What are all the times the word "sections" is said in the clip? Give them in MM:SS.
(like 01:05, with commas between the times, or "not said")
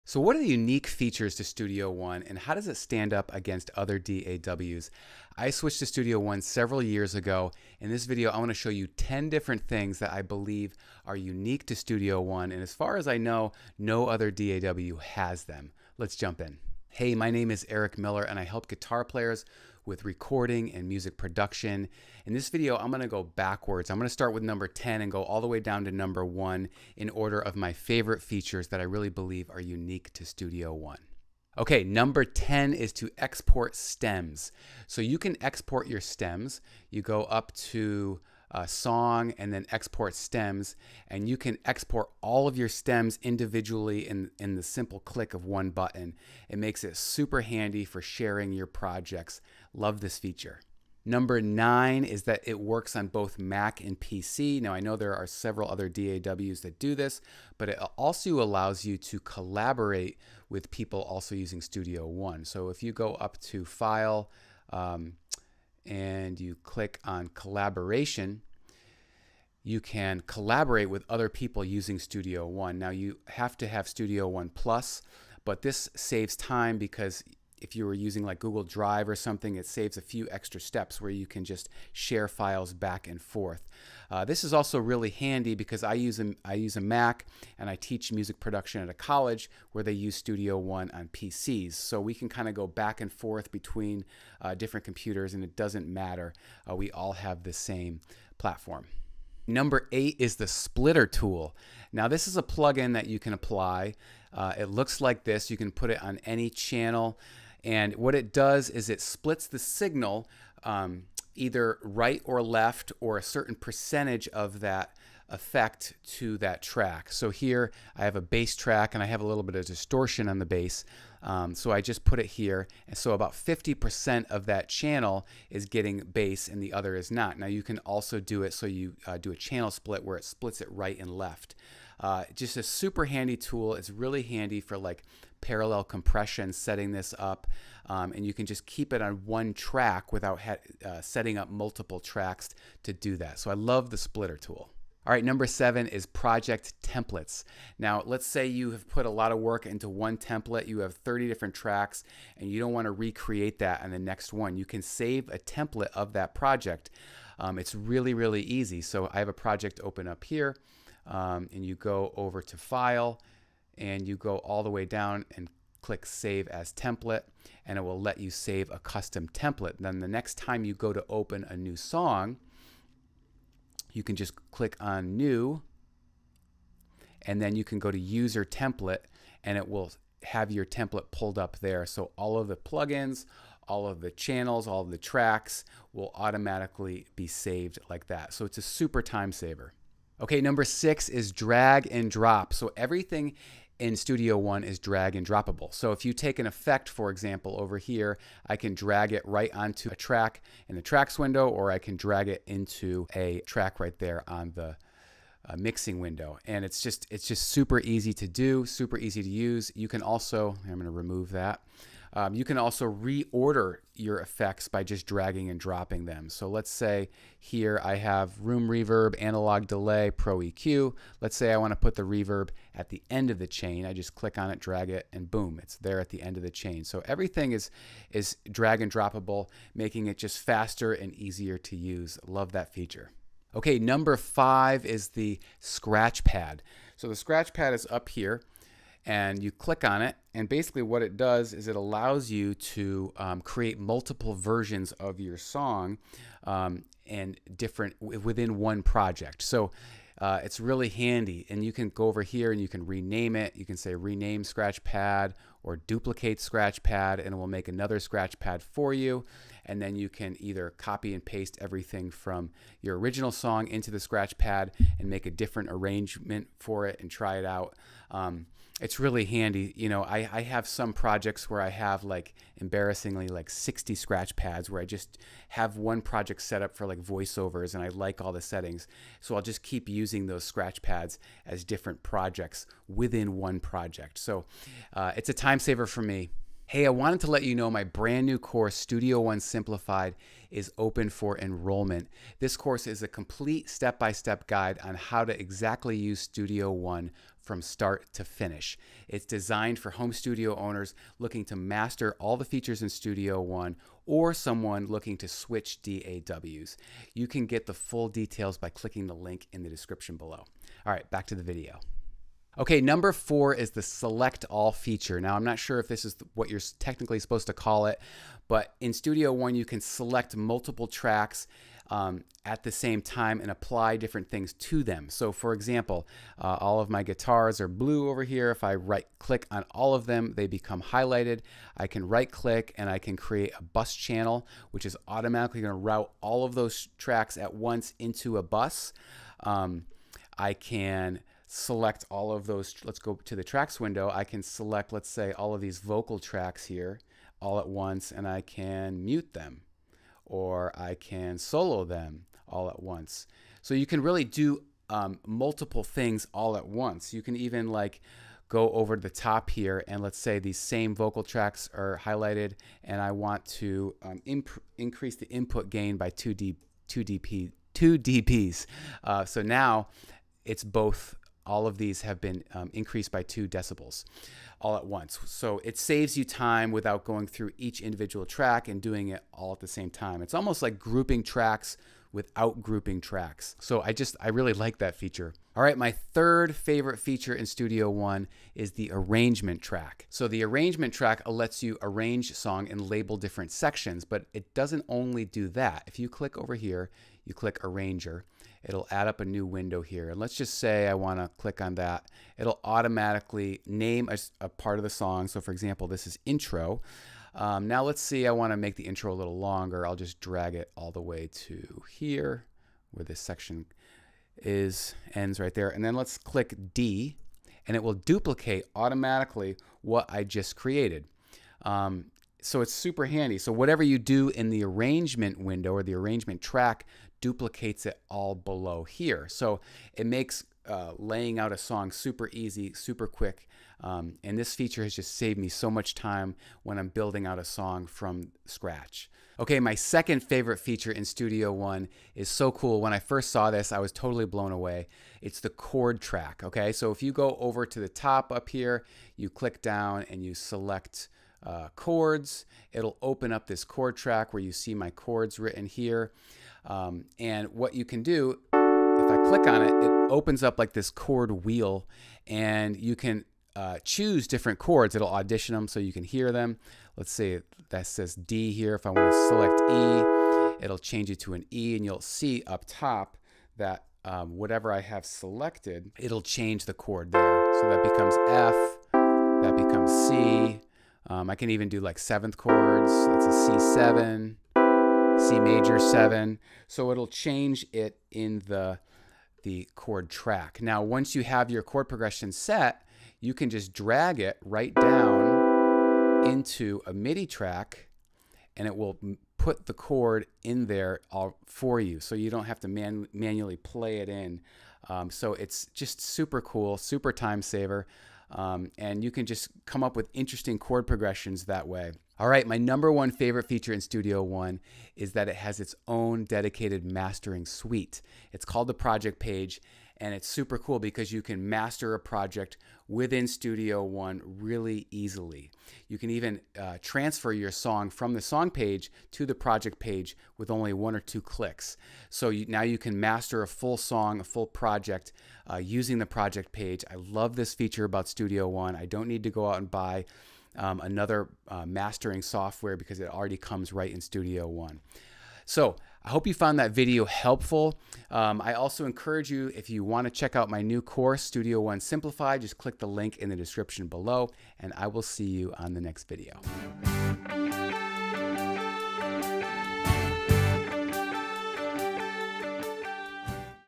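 06:33, 06:53.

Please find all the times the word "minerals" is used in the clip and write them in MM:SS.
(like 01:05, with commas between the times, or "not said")
not said.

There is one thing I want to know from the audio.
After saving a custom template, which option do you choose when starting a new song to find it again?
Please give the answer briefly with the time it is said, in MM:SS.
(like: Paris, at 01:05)
User template, at 02:57.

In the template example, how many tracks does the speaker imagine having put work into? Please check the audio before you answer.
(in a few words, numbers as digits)
30.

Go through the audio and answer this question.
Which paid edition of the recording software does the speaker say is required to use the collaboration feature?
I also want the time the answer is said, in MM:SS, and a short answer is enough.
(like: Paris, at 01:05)
Studio One Plus, at 01:13.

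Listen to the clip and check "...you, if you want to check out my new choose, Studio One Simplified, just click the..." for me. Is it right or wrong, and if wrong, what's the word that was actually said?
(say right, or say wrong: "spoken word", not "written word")
wrong: "course", not "choose".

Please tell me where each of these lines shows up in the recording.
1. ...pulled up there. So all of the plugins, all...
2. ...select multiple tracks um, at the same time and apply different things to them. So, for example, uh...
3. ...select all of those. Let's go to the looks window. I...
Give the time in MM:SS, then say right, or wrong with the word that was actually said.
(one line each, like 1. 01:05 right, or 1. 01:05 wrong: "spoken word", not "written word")
1. 03:01 right
2. 05:19 right
3. 05:41 wrong: "tracks", not "looks".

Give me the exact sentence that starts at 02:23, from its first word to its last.
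So I love the splitter tool.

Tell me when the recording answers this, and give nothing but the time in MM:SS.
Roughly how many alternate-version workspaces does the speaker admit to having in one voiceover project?
04:33.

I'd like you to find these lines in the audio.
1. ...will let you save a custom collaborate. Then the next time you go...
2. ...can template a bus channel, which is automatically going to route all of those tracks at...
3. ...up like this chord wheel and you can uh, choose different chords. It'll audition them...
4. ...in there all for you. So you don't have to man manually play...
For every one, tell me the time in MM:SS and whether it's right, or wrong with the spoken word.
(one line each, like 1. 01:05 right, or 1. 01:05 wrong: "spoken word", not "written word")
1. 02:47 wrong: "template", not "collaborate"
2. 05:32 wrong: "create", not "template"
3. 07:40 right
4. 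08:20 right.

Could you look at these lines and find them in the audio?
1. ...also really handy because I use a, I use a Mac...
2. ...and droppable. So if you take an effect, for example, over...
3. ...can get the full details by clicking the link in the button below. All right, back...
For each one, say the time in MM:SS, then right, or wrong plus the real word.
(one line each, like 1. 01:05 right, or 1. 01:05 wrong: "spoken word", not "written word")
1. 01:24 right
2. 03:15 right
3. 05:07 wrong: "description", not "button".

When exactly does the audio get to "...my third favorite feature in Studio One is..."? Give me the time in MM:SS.
06:25.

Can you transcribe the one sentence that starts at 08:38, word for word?
It's called the project page, and it's super cool because you can master a project within Studio One really easily.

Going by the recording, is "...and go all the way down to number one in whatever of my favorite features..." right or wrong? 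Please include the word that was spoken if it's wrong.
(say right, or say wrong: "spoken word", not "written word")
wrong: "order", not "whatever".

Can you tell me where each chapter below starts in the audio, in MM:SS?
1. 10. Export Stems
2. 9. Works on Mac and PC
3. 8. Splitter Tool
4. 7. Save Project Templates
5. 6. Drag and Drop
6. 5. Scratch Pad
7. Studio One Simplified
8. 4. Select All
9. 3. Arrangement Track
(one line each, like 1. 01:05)
1. 00:31
2. 00:51
3. 01:39
4. 02:24
5. 03:10
6. 03:53
7. 04:46
8. 05:12
9. 06:25.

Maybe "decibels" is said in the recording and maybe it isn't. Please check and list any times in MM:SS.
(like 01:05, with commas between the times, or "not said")
06:13.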